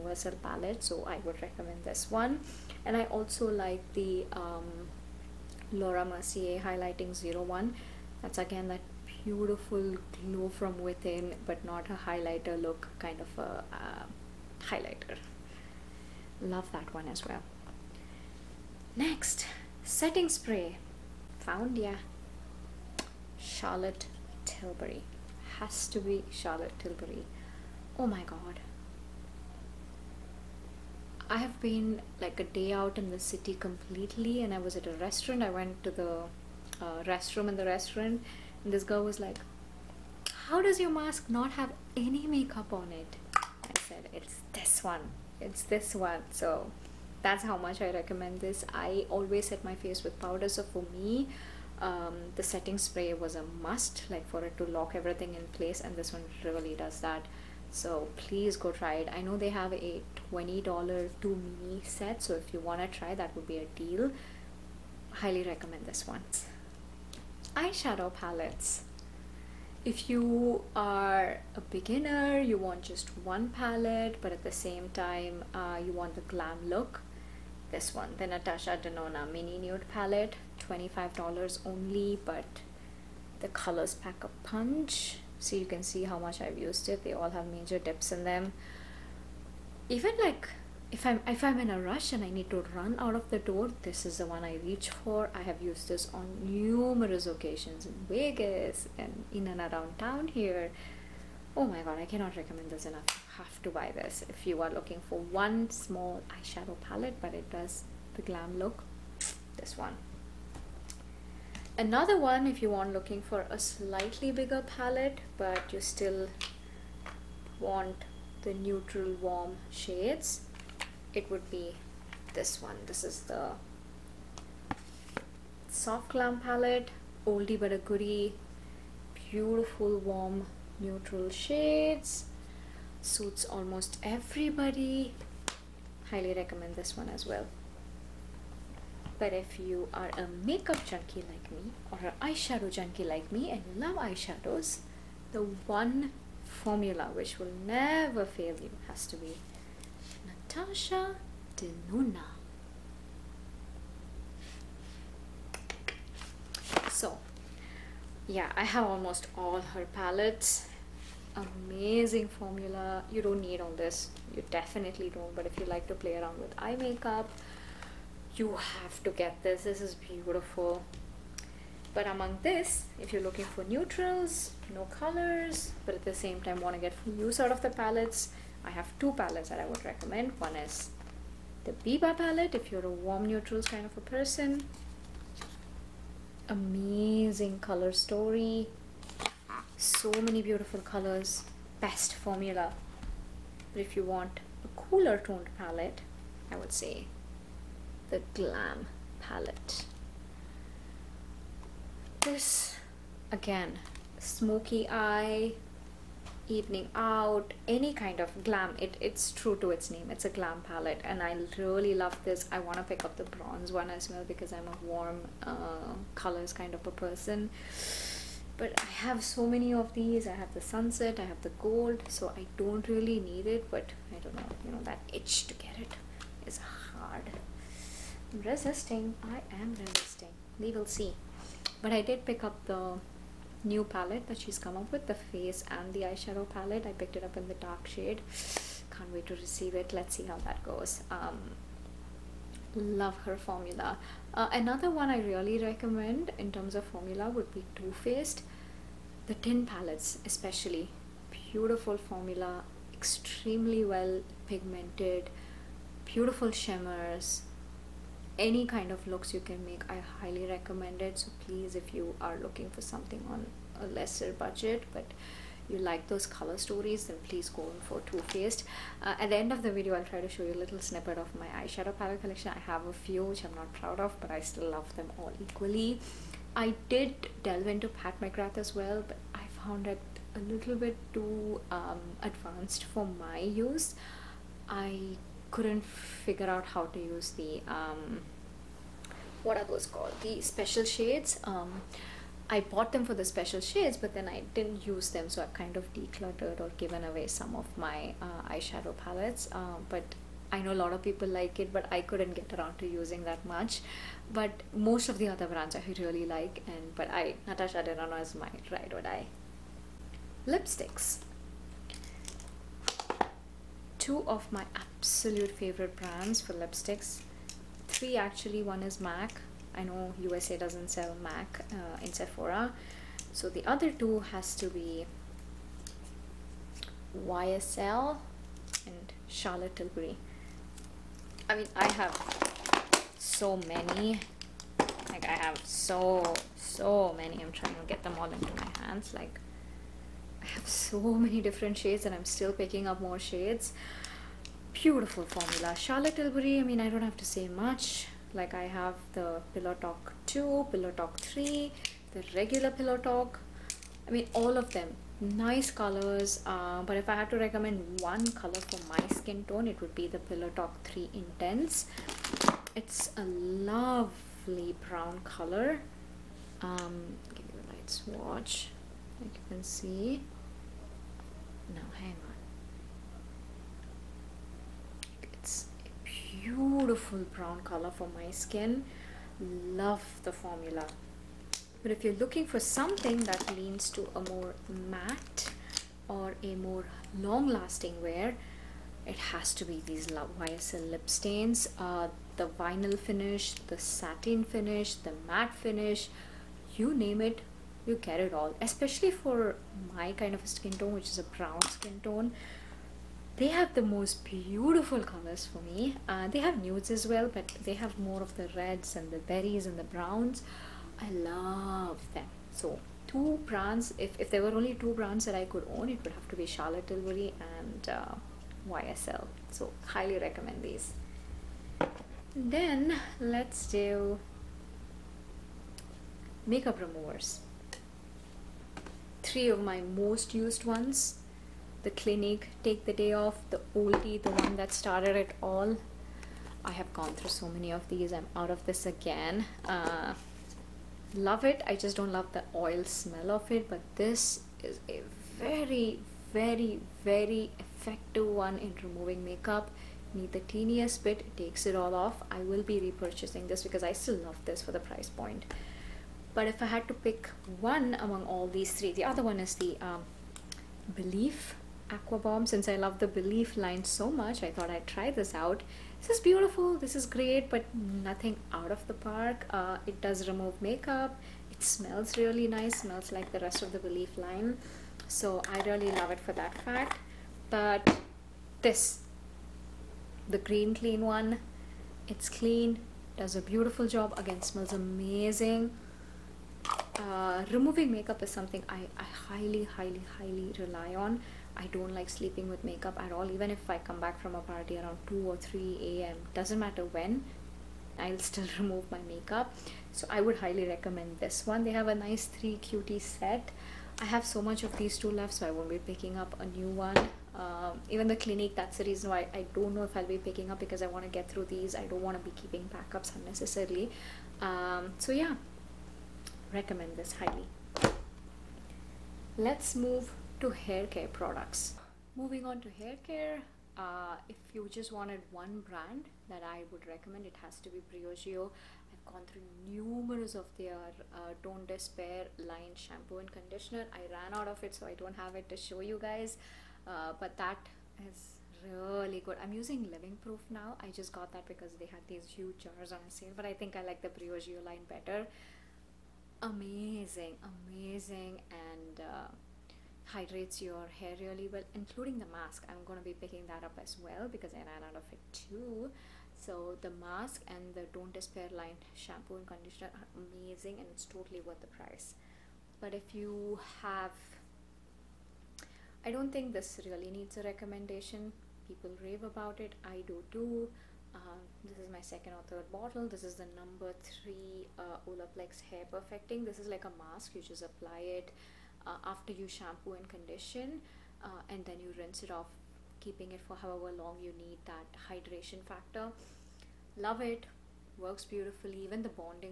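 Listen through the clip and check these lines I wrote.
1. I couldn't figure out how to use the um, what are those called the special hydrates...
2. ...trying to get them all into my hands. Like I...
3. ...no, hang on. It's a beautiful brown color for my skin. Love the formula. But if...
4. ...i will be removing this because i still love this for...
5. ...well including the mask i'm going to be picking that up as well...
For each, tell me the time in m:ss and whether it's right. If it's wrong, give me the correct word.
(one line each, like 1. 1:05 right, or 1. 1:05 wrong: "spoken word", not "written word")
1. 4:44 wrong: "shades", not "hydrates"
2. 5:37 right
3. 6:11 right
4. 7:32 wrong: "repurchasing", not "removing"
5. 9:11 right.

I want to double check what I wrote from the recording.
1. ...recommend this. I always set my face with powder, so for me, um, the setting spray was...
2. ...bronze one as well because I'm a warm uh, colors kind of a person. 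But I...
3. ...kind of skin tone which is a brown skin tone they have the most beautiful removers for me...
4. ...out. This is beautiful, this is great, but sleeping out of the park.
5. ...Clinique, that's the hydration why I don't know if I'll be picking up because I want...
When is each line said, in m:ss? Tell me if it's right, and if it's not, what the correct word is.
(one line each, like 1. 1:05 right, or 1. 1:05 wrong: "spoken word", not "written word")
1. 0:47 right
2. 3:33 right
3. 6:40 wrong: "colors", not "removers"
4. 7:45 wrong: "nothing", not "sleeping"
5. 8:28 wrong: "reason", not "hydration".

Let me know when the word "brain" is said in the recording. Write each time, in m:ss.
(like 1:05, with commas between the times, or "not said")
not said.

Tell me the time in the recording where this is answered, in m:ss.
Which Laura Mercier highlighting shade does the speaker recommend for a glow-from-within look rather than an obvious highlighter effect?
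0:05.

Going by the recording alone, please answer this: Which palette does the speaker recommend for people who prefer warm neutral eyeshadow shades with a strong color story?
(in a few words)
Biba palette.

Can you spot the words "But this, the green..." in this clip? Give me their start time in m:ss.
7:57.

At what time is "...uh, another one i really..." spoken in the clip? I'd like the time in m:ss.
4:04.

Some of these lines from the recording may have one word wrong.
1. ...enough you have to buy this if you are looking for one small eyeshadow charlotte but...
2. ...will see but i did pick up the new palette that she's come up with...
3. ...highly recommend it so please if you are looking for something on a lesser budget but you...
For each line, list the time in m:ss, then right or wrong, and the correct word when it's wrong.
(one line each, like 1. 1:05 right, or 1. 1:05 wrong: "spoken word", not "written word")
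1. 1:42 wrong: "palette", not "charlotte"
2. 3:50 right
3. 4:20 right.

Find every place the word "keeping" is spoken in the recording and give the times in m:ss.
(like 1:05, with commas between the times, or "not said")
8:32, 9:42.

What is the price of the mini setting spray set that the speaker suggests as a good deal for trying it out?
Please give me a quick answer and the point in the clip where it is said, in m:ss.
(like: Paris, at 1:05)
$20, at 1:00.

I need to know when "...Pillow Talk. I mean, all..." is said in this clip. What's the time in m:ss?
5:52.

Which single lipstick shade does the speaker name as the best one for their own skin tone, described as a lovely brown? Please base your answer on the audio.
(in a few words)
Pillow Talk 3 Intense.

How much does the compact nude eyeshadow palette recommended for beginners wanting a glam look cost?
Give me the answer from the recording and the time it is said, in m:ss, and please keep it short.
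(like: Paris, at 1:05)
$25, at 1:20.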